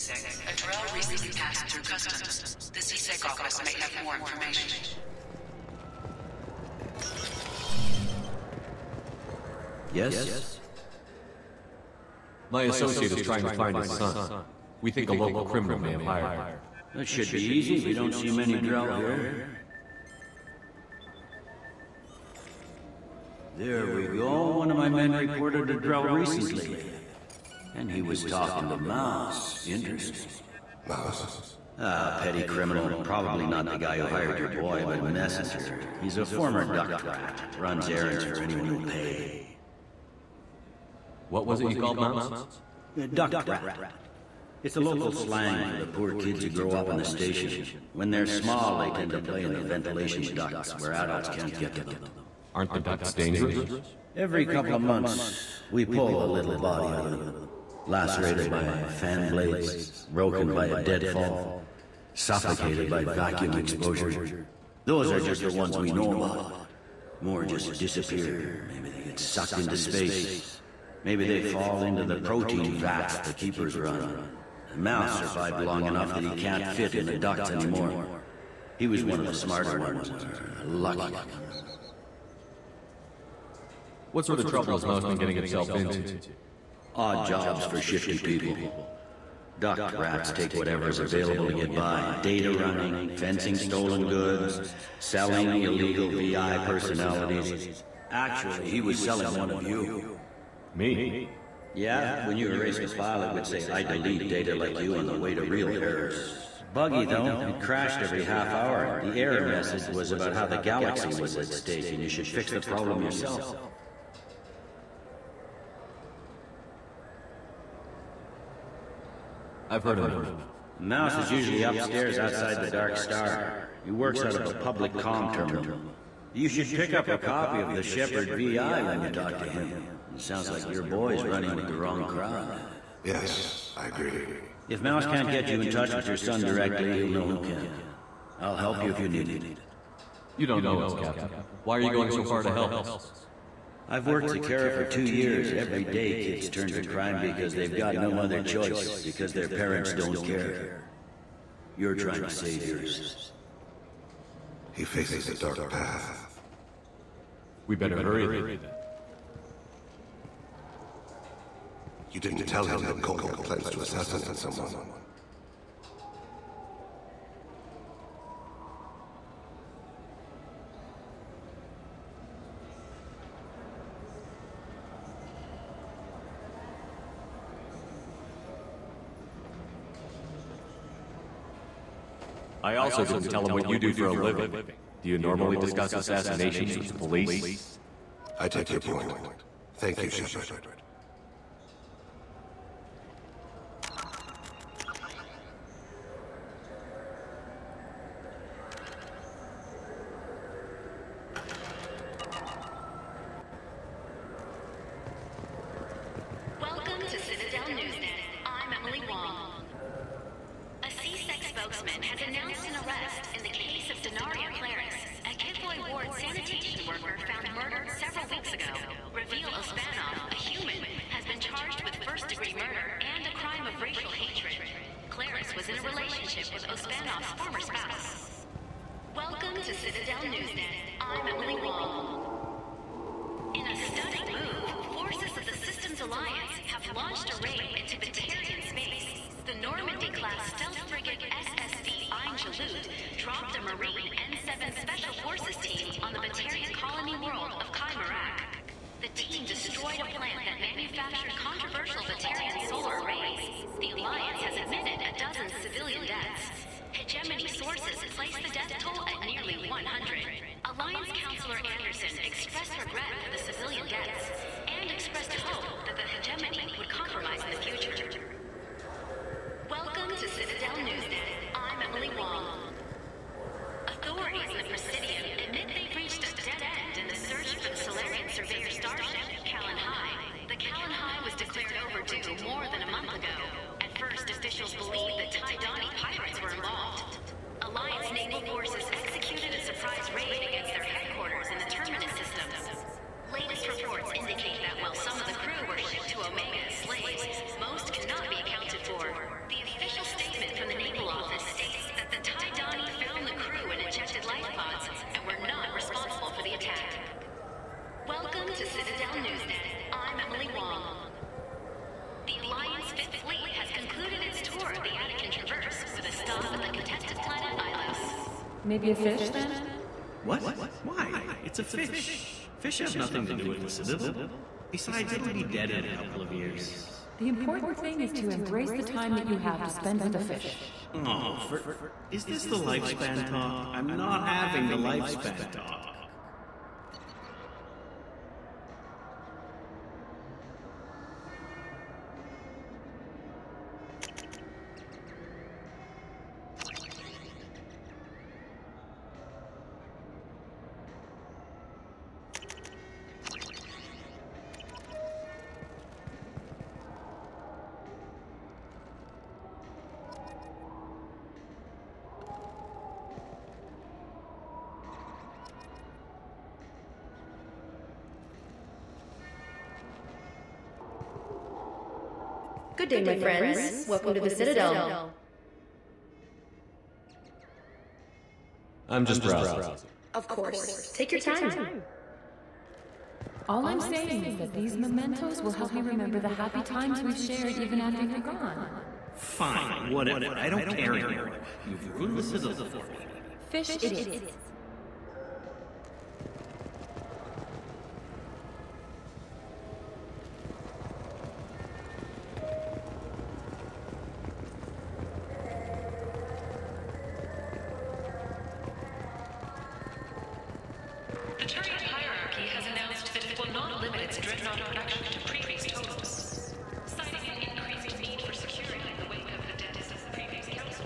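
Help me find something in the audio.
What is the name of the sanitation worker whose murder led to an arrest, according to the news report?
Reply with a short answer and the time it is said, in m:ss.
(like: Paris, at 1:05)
Denaria Claris, at 3:34.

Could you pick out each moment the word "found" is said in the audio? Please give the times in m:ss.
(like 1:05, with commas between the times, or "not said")
3:37, 5:03.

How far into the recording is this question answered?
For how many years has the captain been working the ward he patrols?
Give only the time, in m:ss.
2:24.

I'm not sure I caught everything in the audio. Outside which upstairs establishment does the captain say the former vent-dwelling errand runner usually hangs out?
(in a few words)
the Dark Star.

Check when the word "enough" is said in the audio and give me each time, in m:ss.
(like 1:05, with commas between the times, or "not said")
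1:15, 1:59.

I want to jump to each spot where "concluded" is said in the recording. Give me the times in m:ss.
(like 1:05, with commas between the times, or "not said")
5:13.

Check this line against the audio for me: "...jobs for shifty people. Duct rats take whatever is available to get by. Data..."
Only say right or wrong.
right.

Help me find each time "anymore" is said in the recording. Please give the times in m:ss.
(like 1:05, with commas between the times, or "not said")
1:17, 6:30.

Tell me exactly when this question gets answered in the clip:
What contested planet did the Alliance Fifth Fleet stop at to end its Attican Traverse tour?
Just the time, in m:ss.
5:17.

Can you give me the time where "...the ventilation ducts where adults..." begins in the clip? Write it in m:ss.
0:49.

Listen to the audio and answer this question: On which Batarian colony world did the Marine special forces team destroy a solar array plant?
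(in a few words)
Kaimarak.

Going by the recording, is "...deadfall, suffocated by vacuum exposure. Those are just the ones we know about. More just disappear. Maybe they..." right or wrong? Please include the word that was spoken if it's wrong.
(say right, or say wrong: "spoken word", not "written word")
right.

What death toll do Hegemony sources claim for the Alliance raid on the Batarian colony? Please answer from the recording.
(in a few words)
nearly 100.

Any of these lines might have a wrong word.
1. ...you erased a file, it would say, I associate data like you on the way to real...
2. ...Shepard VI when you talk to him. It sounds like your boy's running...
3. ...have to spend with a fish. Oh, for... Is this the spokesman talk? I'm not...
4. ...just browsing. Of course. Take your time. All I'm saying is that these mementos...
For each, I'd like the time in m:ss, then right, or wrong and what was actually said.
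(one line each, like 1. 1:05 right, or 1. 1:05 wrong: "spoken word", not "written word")
1. 1:42 wrong: "delete", not "associate"
2. 2:07 right
3. 5:29 wrong: "lifespan", not "spokesman"
4. 6:19 right.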